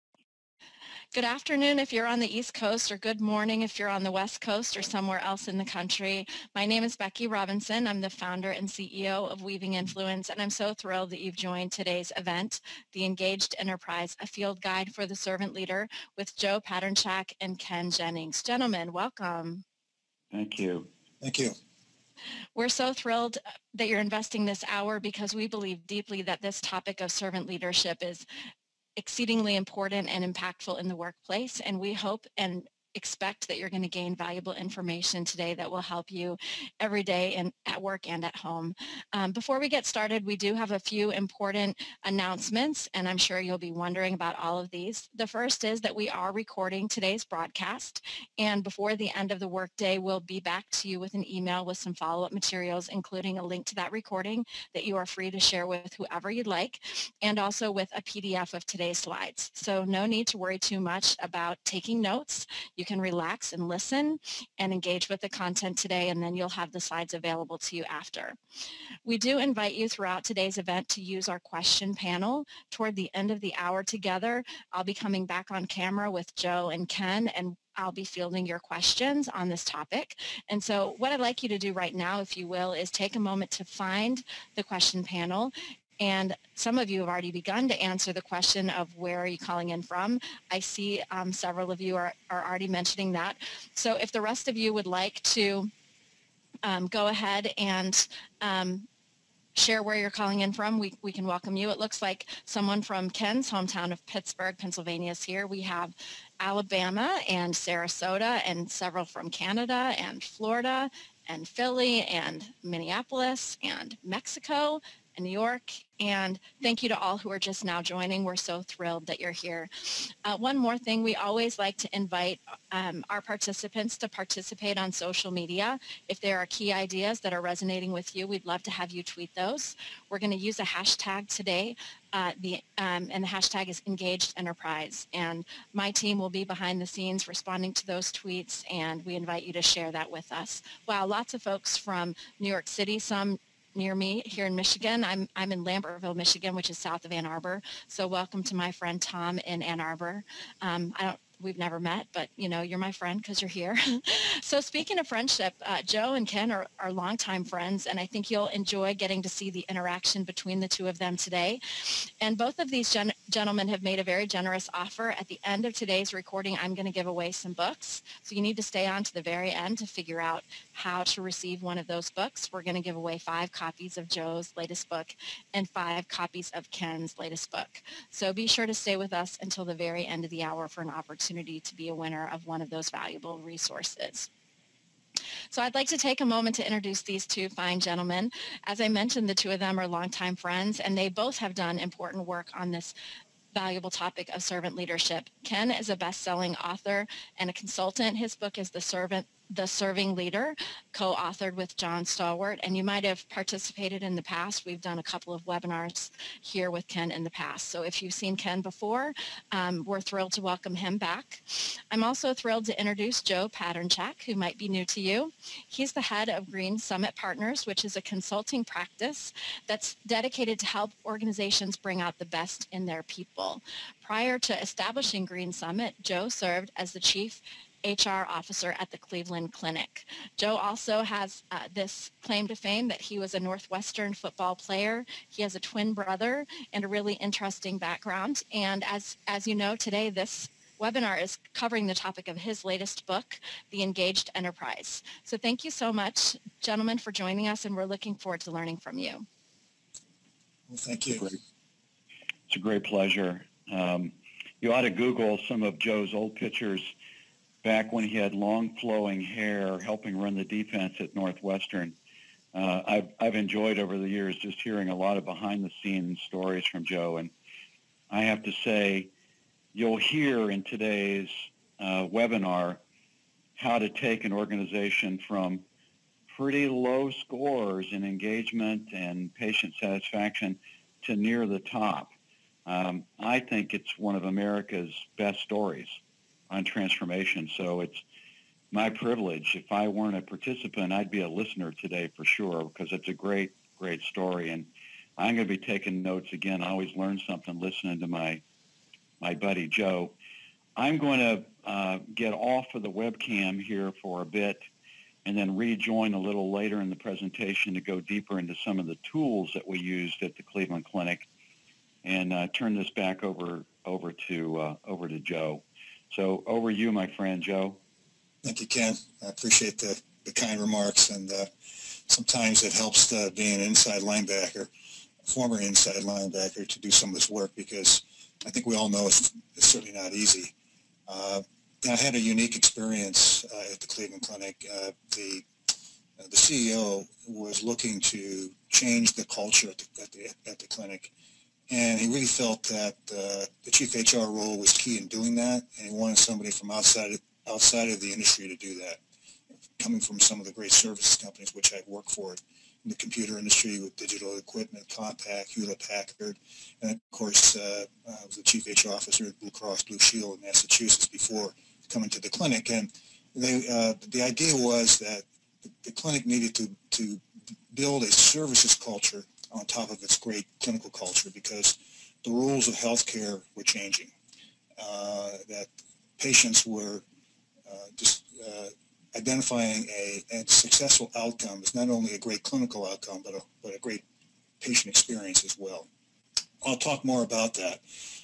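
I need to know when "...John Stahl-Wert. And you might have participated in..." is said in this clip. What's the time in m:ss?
3:21.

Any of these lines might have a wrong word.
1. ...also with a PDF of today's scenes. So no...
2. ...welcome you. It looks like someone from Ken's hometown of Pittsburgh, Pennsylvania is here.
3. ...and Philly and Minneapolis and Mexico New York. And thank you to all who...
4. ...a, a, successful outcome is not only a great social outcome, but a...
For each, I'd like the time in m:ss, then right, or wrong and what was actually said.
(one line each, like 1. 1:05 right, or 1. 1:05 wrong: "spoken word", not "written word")
1. 0:57 wrong: "slides", not "scenes"
2. 1:41 right
3. 1:51 right
4. 6:19 wrong: "clinical", not "social".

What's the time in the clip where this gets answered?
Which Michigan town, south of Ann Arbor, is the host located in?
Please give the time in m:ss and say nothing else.
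2:25.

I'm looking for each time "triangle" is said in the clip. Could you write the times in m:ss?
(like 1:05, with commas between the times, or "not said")
not said.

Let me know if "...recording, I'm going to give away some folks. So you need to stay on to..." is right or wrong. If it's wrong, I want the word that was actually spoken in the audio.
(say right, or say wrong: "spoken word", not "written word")
wrong: "books", not "folks".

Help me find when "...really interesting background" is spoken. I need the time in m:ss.
3:56.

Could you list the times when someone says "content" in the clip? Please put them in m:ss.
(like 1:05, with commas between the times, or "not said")
1:05.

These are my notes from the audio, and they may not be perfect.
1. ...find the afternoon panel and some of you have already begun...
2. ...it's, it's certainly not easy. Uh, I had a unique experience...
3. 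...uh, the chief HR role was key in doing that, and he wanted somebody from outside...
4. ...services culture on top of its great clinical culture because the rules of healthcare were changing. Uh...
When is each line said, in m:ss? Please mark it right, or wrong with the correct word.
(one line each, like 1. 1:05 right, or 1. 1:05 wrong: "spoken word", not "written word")
1. 1:23 wrong: "question", not "afternoon"
2. 5:29 right
3. 5:43 right
4. 6:08 right.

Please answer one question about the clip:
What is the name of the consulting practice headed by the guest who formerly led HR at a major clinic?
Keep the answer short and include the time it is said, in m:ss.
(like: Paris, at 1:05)
Green Summit Partners, at 3:36.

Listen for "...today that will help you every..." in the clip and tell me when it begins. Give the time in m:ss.
0:35.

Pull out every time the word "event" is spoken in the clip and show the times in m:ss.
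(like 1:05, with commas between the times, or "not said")
0:12, 1:10.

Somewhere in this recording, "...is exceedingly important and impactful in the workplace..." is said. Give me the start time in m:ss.
0:28.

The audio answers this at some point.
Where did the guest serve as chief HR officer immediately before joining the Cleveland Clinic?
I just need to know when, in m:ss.
5:59.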